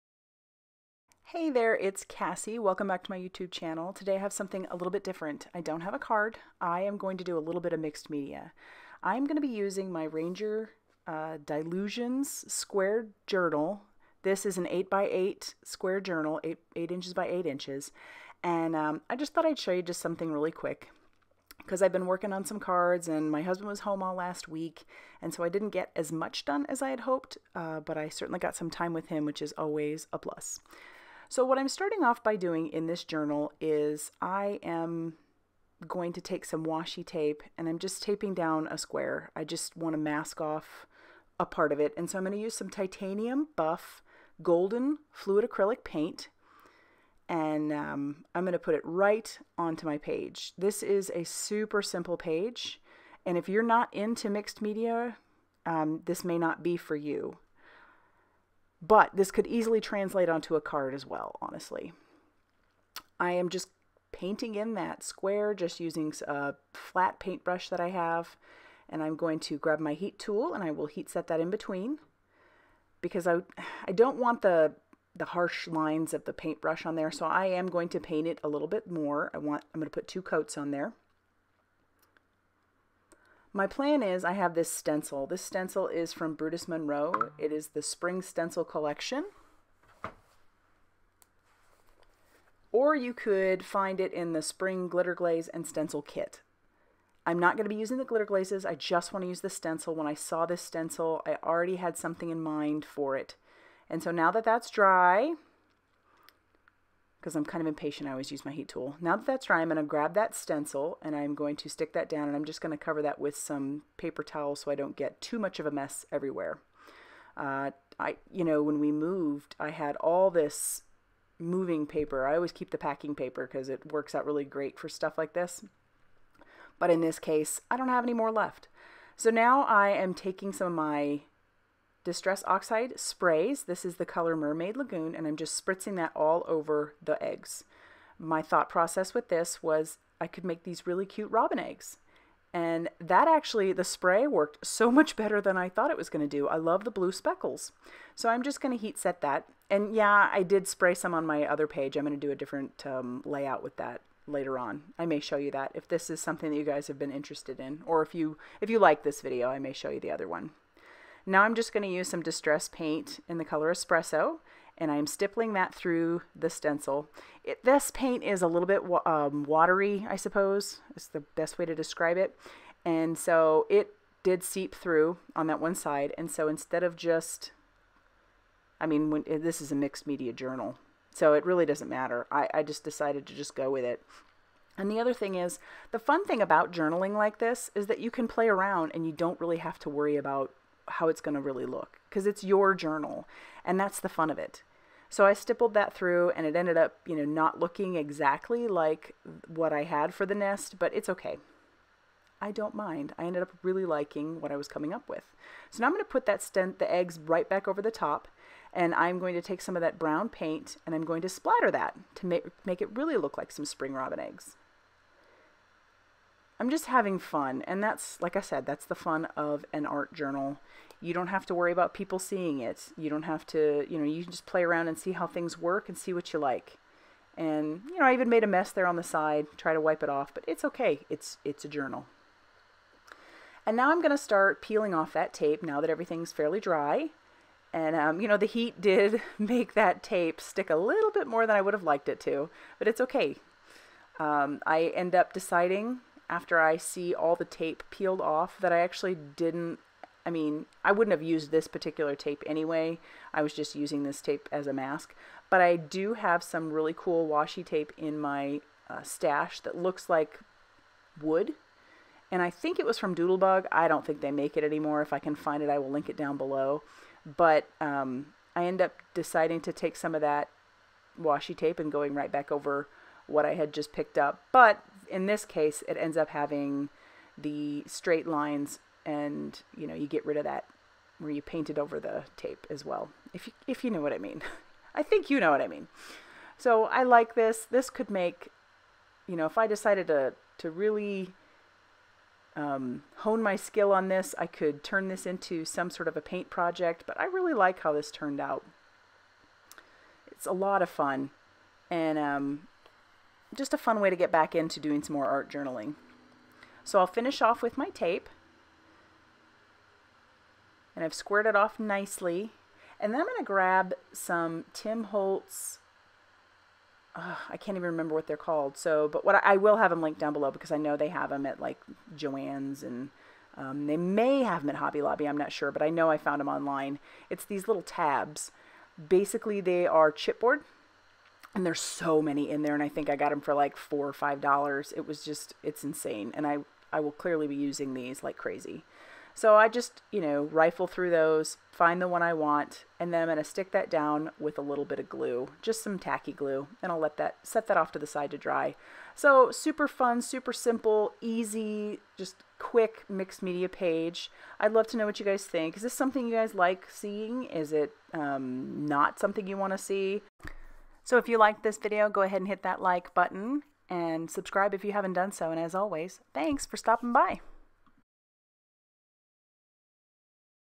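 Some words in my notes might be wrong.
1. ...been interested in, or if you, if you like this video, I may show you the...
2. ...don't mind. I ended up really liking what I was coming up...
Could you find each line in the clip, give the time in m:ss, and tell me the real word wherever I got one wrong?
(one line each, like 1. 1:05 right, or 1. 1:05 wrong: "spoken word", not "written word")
1. 2:36 right
2. 3:22 right.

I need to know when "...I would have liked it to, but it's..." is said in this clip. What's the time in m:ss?
4:01.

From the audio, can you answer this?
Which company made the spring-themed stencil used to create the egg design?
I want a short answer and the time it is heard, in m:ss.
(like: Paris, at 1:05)
Brutus Monroe, at 1:26.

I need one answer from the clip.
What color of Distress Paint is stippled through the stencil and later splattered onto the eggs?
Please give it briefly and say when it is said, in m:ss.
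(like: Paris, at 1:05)
Espresso, at 2:43.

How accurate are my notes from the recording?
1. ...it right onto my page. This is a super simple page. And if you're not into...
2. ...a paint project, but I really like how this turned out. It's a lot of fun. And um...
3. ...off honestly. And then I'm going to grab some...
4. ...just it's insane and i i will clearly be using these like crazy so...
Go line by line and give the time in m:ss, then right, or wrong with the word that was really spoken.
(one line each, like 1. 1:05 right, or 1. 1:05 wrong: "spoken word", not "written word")
1. 0:48 right
2. 4:56 right
3. 5:11 wrong: "nicely", not "honestly"
4. 5:35 right.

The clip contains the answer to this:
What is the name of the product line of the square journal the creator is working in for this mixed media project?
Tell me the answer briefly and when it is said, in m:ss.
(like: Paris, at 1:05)
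Dylusions Squared Journal, at 0:11.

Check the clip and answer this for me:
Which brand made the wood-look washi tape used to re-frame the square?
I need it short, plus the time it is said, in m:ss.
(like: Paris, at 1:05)
Doodlebug, at 4:23.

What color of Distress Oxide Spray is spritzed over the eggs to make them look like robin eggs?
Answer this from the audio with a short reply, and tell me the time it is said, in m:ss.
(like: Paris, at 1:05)
Mermaid Lagoon, at 2:14.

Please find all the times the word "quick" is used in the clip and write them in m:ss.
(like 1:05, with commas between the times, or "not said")
0:20, 5:52.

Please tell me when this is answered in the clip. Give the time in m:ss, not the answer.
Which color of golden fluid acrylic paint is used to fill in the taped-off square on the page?
0:42.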